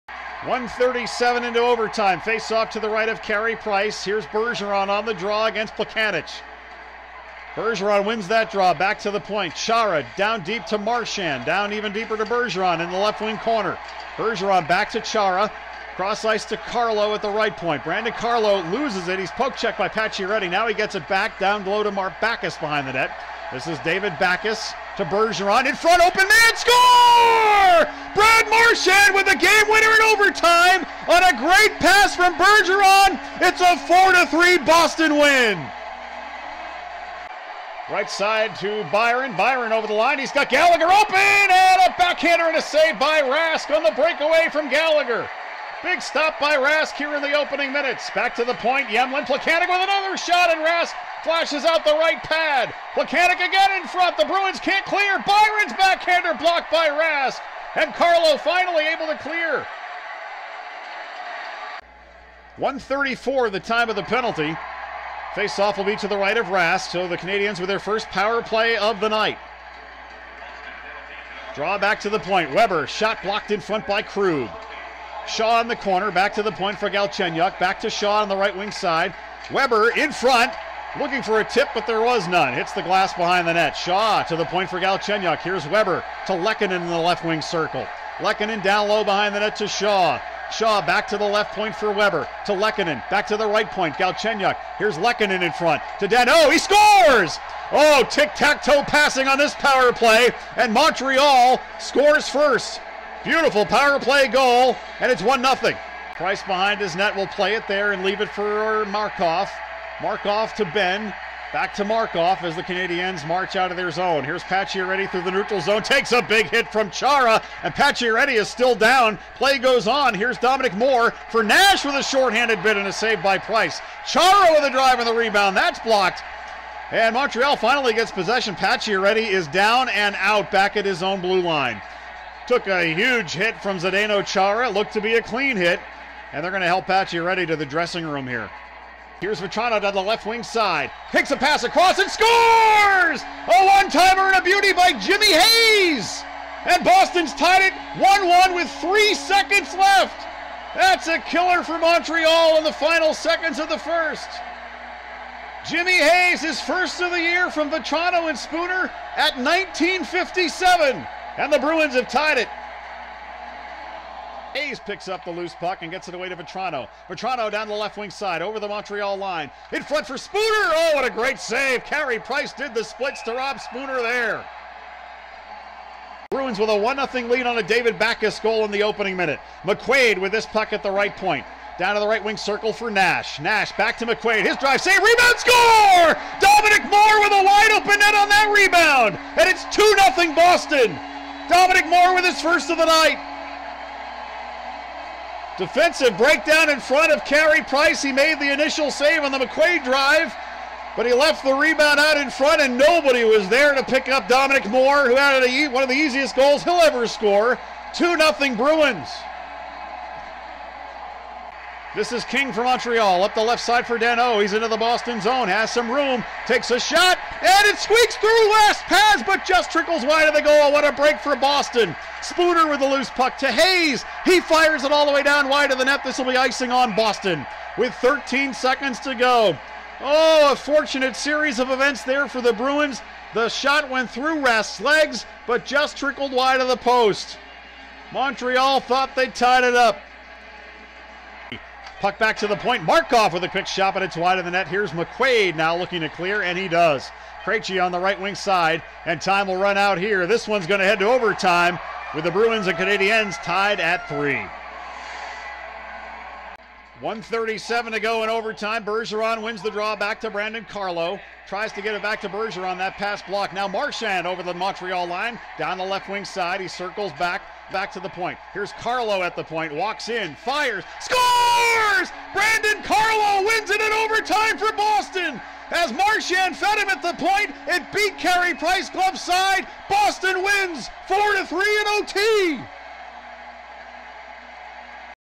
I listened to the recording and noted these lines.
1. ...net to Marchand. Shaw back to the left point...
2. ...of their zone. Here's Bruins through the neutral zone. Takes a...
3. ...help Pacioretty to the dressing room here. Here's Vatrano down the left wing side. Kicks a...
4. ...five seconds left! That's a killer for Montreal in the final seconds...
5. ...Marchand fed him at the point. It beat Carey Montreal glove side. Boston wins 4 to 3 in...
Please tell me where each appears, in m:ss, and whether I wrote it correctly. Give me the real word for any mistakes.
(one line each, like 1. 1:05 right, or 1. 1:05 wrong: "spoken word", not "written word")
1. 1:29 wrong: "Shaw", not "Marchand"
2. 1:53 wrong: "Pacioretty", not "Bruins"
3. 2:16 right
4. 2:28 wrong: "three", not "five"
5. 4:35 wrong: "Price", not "Montreal".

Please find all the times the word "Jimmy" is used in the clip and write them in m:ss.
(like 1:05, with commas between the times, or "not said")
2:24, 2:35.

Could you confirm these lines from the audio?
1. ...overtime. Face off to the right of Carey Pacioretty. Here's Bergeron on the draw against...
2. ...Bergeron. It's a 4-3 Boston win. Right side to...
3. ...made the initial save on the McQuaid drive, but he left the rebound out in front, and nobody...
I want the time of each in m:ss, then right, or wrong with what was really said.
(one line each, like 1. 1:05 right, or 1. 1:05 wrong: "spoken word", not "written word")
1. 0:01 wrong: "Price", not "Pacioretty"
2. 0:32 right
3. 3:18 right.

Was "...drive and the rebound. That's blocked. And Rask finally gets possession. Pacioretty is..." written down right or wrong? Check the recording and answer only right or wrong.
wrong.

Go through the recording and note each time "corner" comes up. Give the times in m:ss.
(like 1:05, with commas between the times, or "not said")
0:13, 1:15.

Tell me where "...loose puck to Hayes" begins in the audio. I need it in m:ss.
3:42.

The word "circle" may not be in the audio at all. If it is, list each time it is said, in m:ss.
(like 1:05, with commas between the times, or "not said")
1:27, 3:02, 4:26.